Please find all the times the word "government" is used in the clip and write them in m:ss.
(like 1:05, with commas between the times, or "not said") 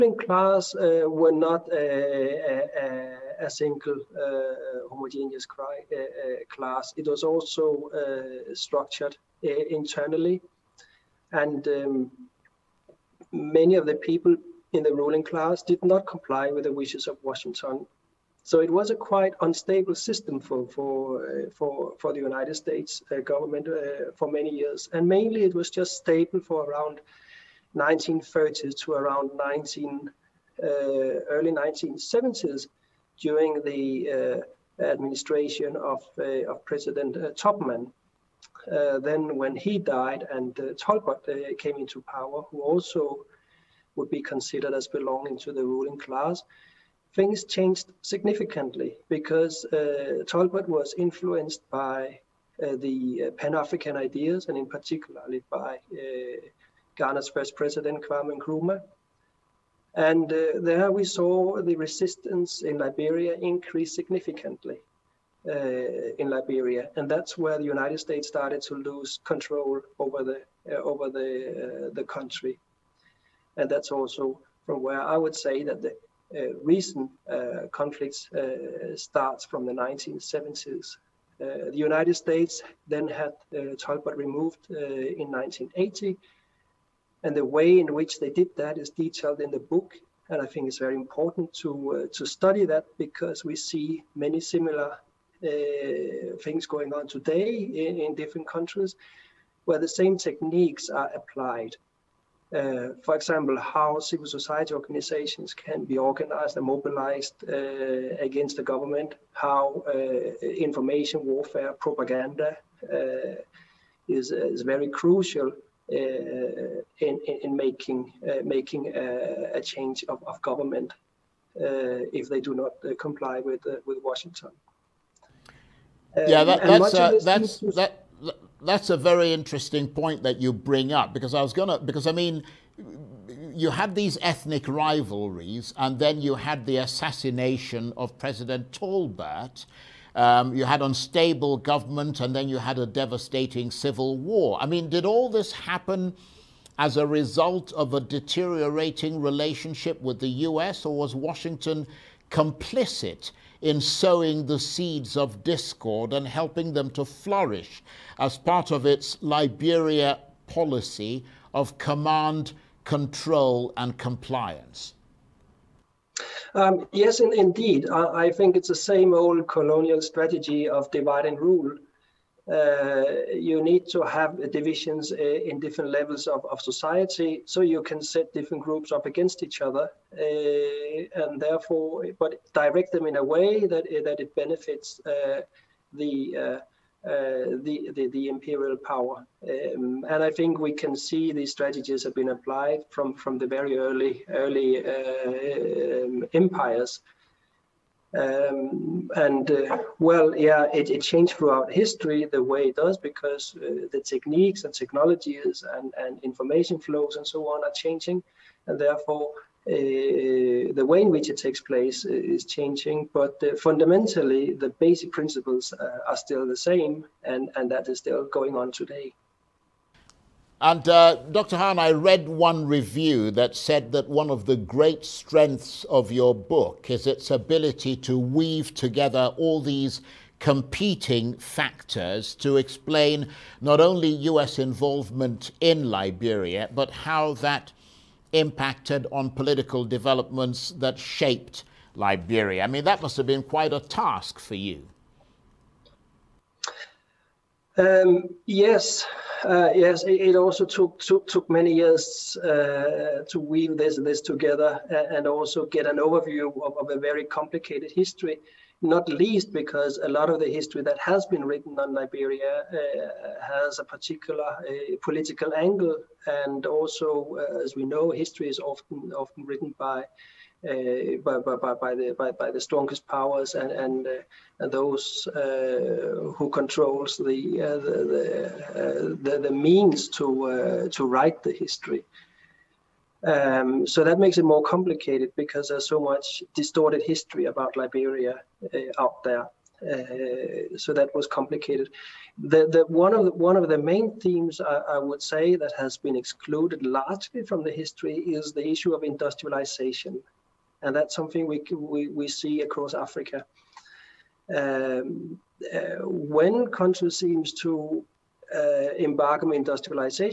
0:23, 1:48, 2:00, 2:21.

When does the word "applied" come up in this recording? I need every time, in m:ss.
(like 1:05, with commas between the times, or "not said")
1:41, 3:12.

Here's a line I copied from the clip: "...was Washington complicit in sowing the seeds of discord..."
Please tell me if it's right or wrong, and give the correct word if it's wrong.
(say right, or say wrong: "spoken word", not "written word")
right.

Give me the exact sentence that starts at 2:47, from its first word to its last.
I, I, think it's the same old colonial strategy of divide and rule.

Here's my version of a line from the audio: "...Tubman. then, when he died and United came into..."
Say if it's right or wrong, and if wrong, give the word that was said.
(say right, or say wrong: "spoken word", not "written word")
wrong: "Tolbert", not "United".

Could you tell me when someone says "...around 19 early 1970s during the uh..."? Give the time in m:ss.
0:28.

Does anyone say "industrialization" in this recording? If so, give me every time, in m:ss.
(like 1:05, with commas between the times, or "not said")
4:59, 5:09.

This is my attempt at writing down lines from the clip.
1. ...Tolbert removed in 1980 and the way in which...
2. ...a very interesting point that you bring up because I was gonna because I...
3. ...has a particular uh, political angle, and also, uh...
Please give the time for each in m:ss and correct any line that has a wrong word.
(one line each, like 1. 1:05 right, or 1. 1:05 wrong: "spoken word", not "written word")
1. 1:23 right
2. 2:08 right
3. 4:23 right.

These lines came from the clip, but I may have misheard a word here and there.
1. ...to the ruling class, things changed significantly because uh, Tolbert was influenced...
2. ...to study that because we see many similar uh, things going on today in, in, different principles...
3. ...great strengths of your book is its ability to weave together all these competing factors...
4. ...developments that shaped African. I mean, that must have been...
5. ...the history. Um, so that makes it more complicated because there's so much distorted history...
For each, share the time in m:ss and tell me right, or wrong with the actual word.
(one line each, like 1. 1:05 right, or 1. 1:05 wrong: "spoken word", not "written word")
1. 0:45 right
2. 1:32 wrong: "countries", not "principles"
3. 3:44 right
4. 3:59 wrong: "Liberia", not "African"
5. 4:41 right.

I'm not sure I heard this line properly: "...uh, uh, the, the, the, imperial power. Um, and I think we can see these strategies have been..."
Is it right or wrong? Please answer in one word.
right.